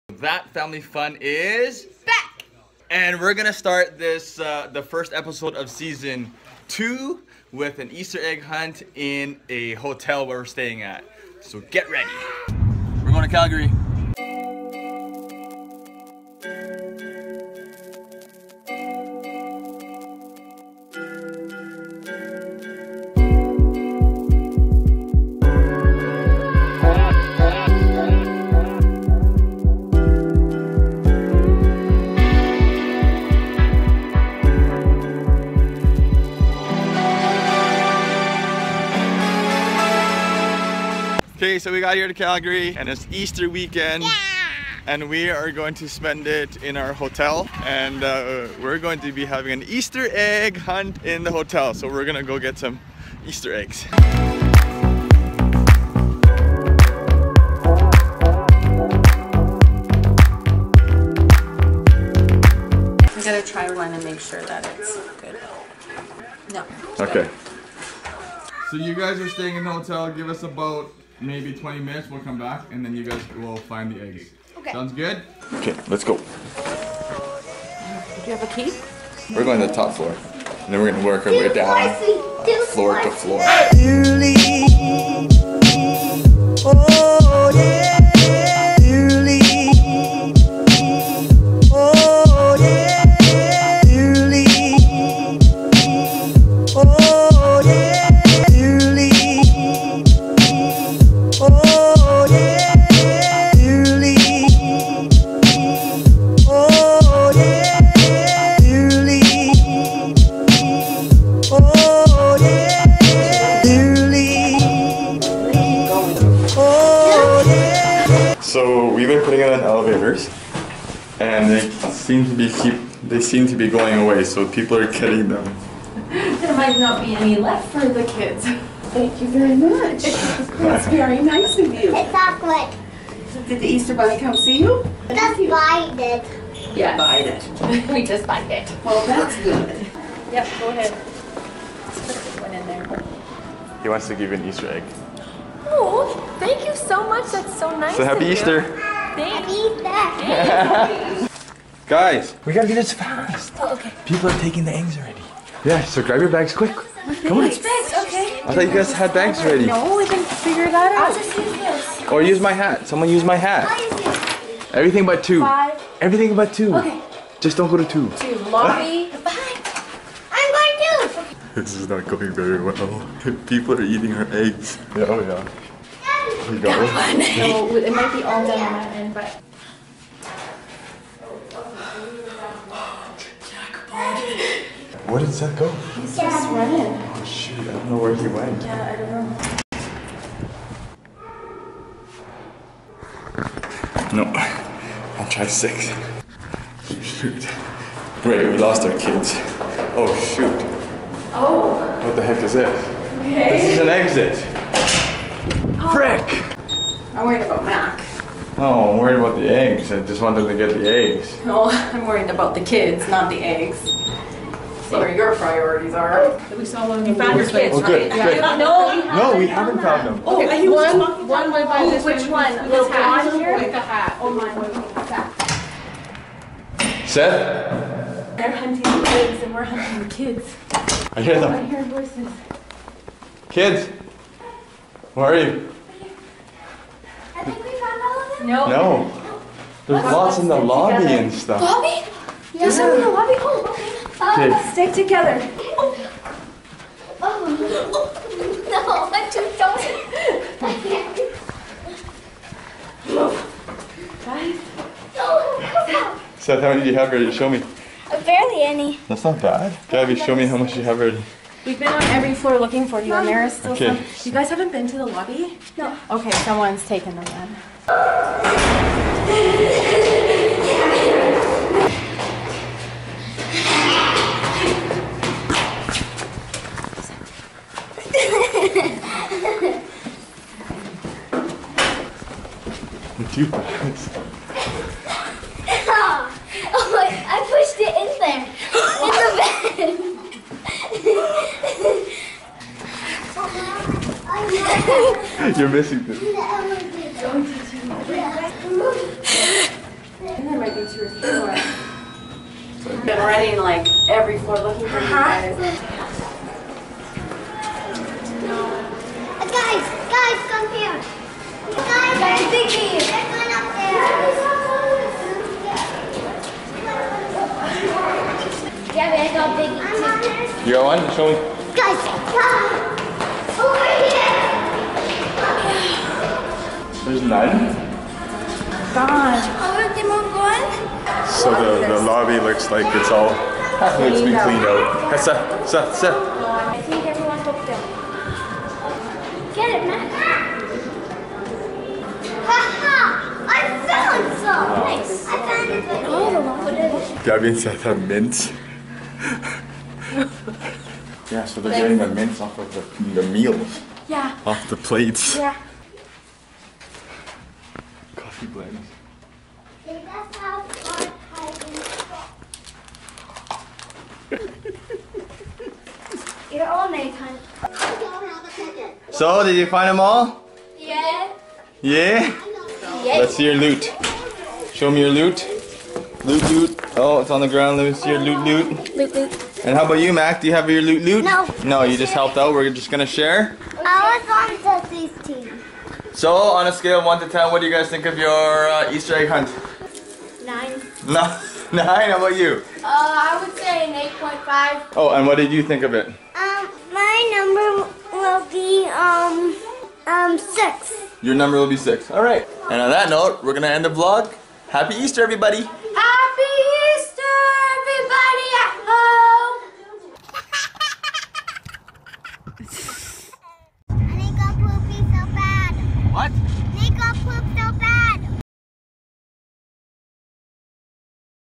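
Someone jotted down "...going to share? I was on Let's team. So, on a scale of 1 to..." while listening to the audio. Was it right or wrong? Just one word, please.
wrong.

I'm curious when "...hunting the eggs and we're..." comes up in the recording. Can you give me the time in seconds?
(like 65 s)
228 s.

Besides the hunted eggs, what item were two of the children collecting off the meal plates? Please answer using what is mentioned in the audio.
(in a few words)
mints.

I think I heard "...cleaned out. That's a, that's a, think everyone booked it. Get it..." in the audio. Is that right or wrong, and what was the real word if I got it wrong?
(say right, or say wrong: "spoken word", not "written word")
right.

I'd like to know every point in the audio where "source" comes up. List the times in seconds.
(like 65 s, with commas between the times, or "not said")
not said.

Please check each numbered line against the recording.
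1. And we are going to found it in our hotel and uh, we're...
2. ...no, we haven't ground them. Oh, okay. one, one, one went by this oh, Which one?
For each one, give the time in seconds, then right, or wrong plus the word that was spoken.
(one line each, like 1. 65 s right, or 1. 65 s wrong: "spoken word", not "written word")
1. 44 s wrong: "spend", not "found"
2. 219 s wrong: "found", not "ground".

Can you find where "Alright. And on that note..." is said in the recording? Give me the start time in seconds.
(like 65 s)
402 s.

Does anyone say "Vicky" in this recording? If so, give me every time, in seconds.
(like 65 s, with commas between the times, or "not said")
312 s, 320 s.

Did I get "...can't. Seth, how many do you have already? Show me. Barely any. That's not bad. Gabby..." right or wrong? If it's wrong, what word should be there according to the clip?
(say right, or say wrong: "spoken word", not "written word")
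wrong: "ready", not "already".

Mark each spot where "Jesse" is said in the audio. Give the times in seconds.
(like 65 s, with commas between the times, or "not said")
384 s.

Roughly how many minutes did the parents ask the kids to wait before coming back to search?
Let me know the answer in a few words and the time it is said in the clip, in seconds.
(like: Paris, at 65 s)
20, at 71 s.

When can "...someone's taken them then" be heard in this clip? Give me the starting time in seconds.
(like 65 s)
266 s.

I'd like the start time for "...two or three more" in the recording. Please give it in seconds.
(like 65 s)
300 s.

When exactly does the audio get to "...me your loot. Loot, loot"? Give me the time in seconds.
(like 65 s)
374 s.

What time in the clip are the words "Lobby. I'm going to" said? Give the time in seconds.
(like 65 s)
168 s.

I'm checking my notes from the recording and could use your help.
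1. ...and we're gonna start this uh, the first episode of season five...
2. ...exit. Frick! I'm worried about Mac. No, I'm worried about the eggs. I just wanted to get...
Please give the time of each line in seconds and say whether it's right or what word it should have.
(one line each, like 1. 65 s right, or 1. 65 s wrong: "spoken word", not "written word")
1. 2 s wrong: "two", not "five"
2. 203 s right.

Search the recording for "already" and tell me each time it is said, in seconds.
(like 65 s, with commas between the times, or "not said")
154 s, 159 s.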